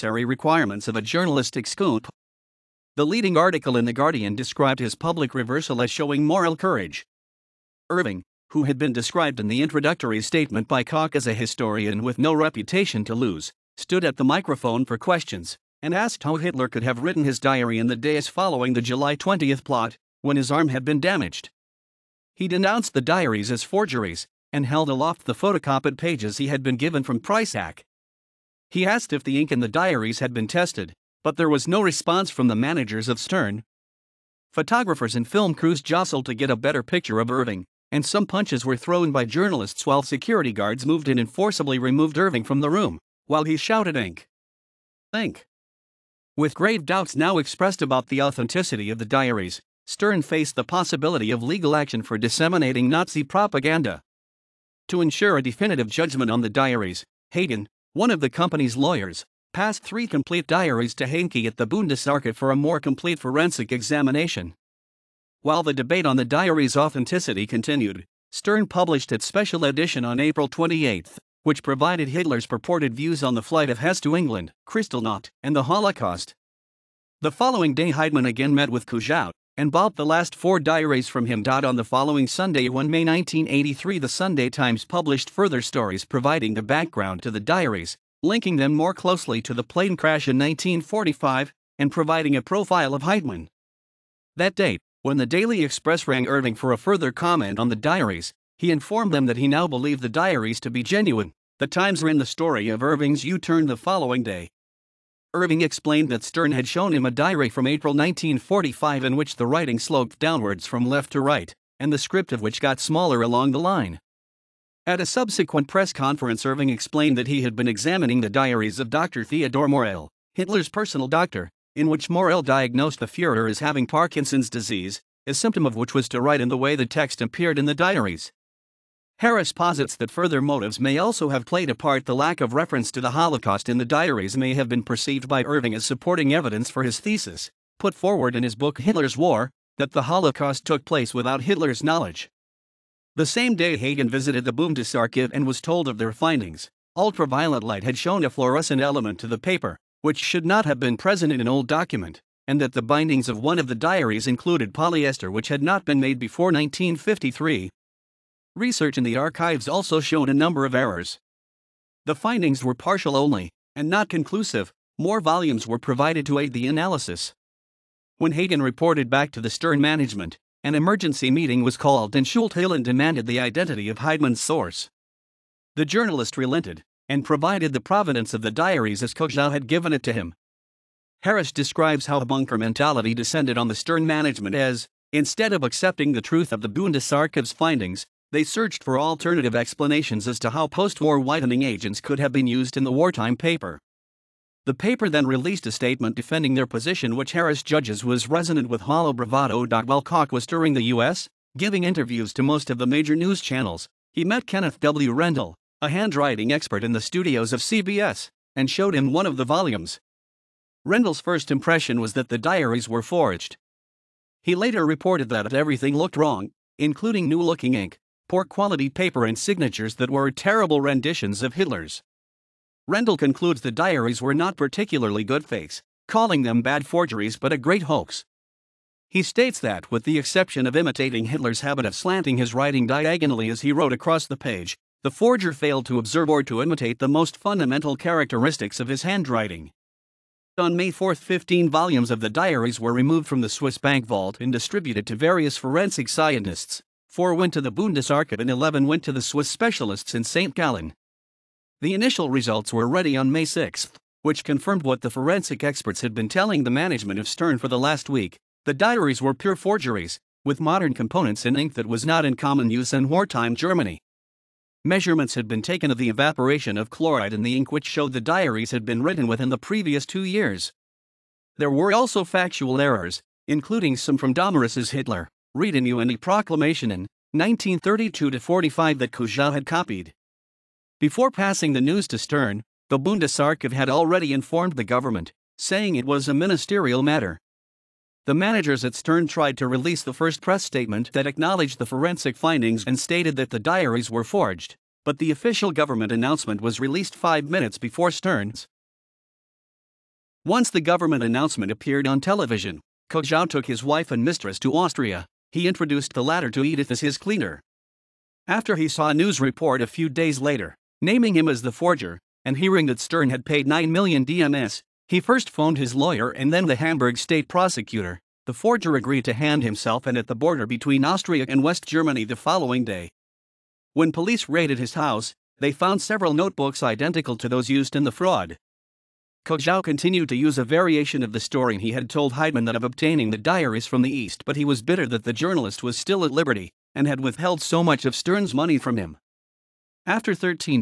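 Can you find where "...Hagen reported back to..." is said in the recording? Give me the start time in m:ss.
2:48.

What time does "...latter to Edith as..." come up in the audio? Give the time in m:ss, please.
5:06.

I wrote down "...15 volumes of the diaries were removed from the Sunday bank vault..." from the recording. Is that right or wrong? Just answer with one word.
wrong.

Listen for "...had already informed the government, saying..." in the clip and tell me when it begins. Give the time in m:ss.
4:43.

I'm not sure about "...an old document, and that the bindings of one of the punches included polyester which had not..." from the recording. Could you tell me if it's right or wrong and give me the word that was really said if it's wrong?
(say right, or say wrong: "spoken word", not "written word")
wrong: "diaries", not "punches".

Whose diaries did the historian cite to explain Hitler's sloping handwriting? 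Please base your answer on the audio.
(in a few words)
Dr. Theodore Morell.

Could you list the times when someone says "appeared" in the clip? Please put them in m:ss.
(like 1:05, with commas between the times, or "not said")
2:07, 5:01.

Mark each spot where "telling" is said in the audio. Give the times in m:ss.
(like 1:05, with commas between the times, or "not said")
4:16.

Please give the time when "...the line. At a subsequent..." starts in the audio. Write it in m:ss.
1:53.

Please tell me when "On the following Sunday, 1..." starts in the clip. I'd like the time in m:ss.
1:21.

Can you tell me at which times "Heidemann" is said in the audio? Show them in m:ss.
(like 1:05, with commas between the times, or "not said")
1:17, 1:33, 2:53, 5:32.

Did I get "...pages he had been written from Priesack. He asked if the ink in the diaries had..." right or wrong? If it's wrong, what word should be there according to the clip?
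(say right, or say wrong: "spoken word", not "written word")
wrong: "given", not "written".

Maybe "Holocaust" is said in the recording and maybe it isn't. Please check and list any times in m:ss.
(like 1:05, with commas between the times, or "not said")
1:15, 2:13, 2:20.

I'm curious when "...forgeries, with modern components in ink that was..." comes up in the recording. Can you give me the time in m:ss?
4:19.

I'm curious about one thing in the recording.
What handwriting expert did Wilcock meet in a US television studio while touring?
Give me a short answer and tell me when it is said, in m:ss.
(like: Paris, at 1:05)
Kenneth W. Rendell, at 3:24.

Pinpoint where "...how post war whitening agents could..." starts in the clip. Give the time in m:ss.
3:10.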